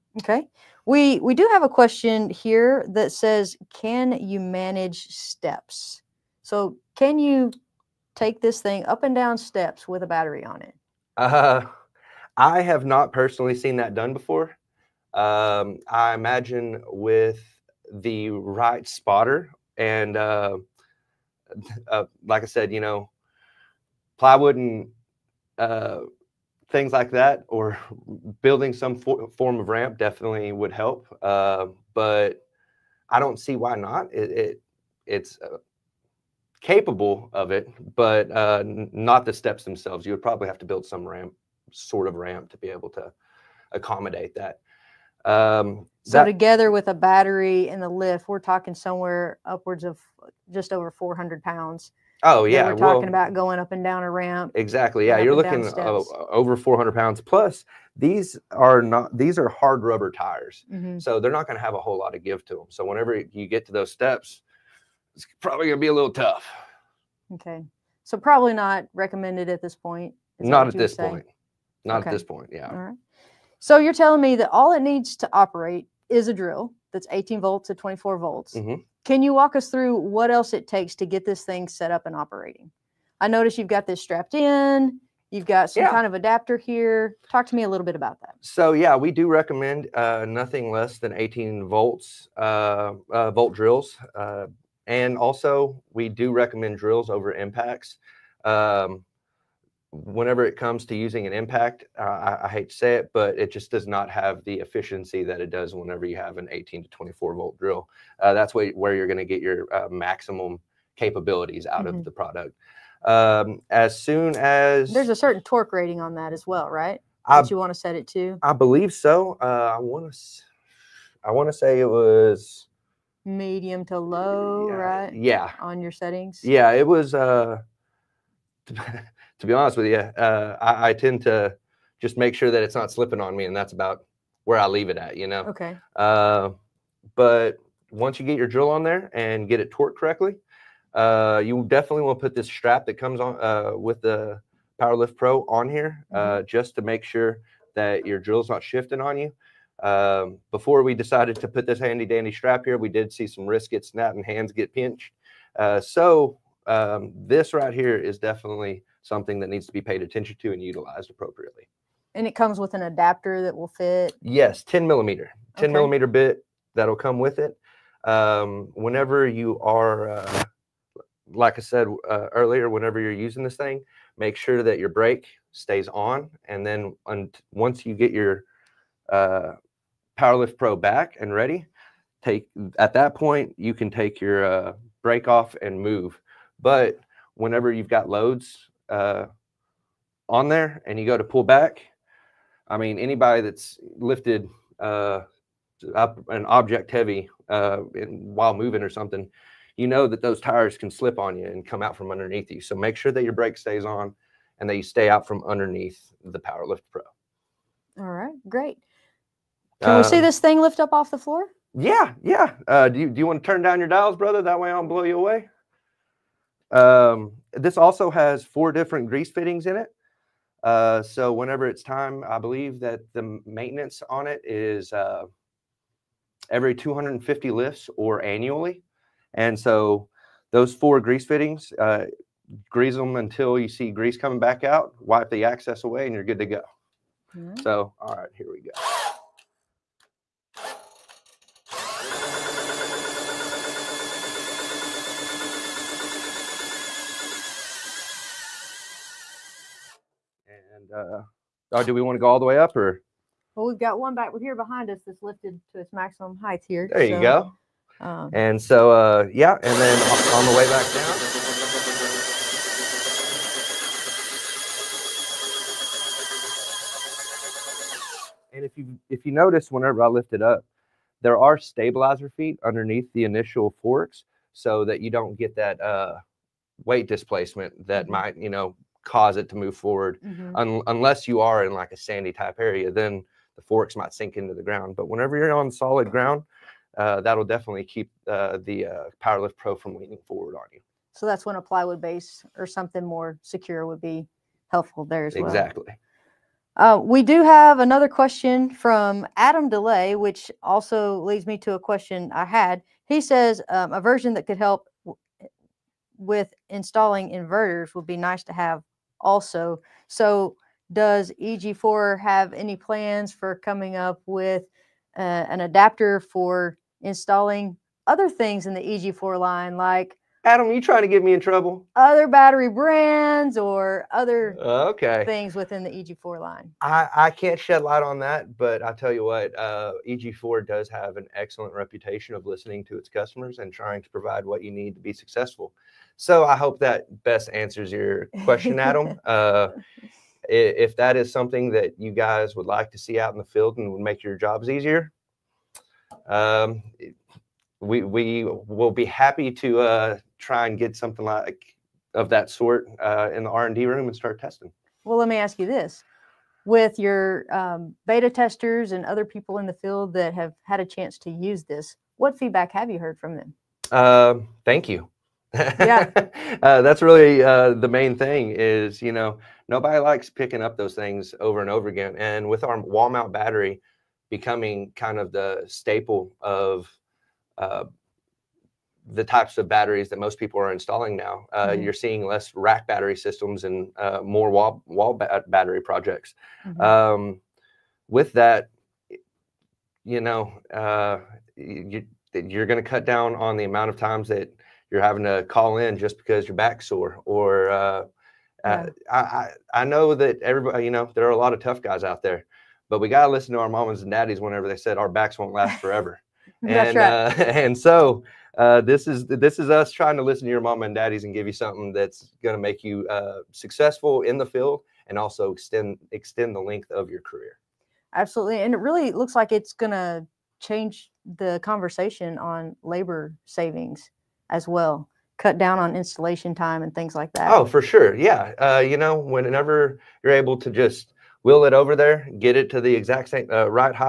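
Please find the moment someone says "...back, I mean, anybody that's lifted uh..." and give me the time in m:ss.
3:11.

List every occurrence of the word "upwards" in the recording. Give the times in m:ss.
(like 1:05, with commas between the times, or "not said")
0:49.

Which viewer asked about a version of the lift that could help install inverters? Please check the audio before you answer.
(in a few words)
Adam Delay.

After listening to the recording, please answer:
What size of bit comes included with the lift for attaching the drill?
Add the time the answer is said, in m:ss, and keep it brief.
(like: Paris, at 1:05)
10 millimeter, at 2:45.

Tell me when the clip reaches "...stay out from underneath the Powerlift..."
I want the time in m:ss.
3:24.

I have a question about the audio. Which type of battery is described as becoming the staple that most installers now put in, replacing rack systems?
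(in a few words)
wall mount battery.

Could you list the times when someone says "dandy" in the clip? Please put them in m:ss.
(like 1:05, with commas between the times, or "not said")
2:32.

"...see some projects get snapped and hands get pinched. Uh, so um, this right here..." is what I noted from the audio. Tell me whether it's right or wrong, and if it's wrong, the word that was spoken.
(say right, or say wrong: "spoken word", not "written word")
wrong: "wrists", not "projects".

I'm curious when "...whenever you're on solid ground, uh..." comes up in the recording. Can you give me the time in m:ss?
4:45.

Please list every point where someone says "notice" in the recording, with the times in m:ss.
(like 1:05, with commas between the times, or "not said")
1:23, 4:29.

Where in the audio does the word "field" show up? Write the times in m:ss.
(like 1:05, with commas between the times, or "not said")
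5:43, 5:59, 6:54.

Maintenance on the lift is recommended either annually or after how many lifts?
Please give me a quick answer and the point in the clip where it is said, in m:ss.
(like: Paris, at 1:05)
250, at 3:46.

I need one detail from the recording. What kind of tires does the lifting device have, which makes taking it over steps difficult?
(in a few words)
hard rubber tires.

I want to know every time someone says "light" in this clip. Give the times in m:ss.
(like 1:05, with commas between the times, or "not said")
5:27.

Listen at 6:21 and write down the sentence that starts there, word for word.
you're seeing less rack battery systems and uh, more wall, wall ba- battery projects.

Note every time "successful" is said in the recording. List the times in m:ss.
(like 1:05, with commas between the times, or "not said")
5:35, 6:53.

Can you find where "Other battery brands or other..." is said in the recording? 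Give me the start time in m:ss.
5:21.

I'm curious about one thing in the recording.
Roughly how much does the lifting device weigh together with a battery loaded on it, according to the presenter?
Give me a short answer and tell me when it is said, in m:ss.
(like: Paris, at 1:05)
over 400 pounds, at 0:50.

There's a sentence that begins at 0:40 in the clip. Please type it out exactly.
You would probably have to build some ramp, sort of ramp, to be able to accommodate that.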